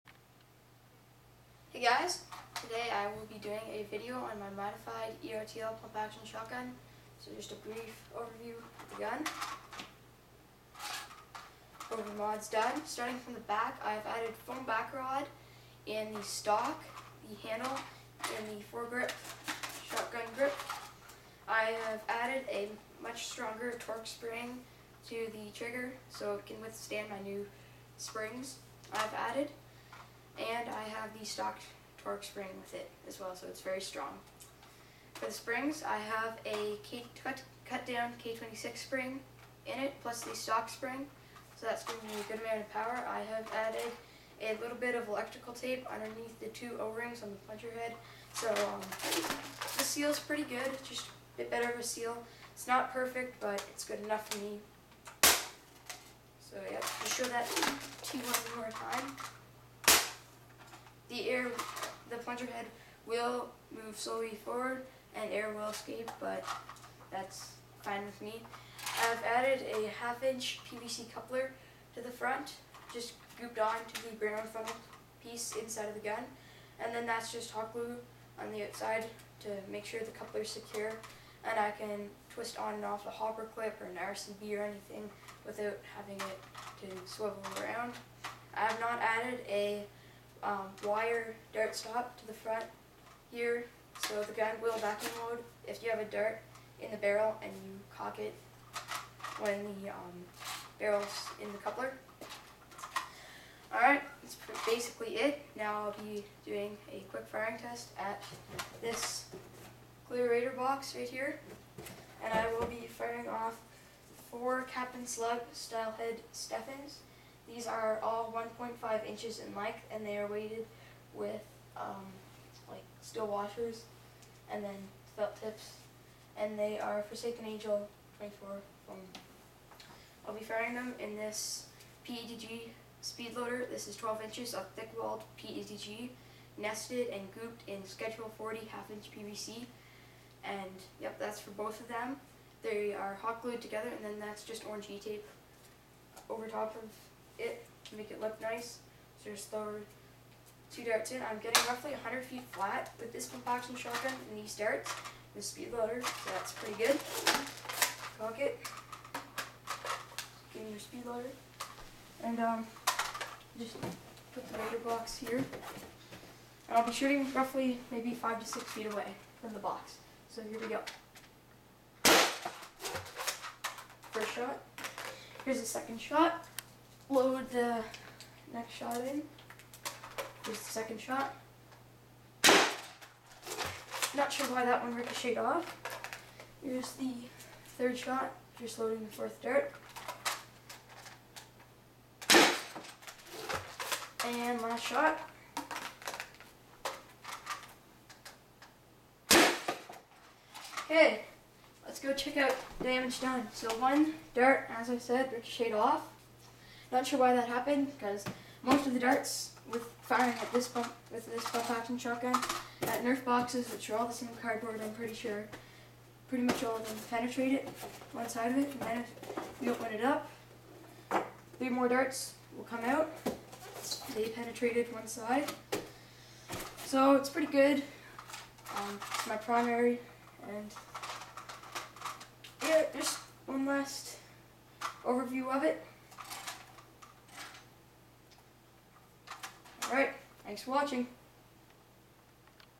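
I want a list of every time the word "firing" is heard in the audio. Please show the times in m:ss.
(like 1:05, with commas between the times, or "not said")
1:47, 1:52, 2:10, 3:30.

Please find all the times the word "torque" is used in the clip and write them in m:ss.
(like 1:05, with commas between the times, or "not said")
0:23, 0:32.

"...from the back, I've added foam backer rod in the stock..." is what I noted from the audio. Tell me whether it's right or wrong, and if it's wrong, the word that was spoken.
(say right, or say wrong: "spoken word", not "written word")
right.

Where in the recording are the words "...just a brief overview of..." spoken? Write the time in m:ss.
0:07.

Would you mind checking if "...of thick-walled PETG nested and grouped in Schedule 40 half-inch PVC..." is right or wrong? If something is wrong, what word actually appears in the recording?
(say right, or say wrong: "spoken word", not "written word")
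right.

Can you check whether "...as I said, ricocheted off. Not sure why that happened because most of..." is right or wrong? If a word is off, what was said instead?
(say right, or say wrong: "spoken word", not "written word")
right.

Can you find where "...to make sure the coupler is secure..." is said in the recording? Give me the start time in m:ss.
1:19.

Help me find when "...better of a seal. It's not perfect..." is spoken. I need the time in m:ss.
0:51.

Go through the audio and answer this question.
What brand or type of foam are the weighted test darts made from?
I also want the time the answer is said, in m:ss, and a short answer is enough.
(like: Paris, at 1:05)
Forsaken Angel 24, at 2:07.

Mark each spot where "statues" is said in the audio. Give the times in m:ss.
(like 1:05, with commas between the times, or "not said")
not said.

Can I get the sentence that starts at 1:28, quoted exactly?
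I have not added a um, wire dart stop to the front here.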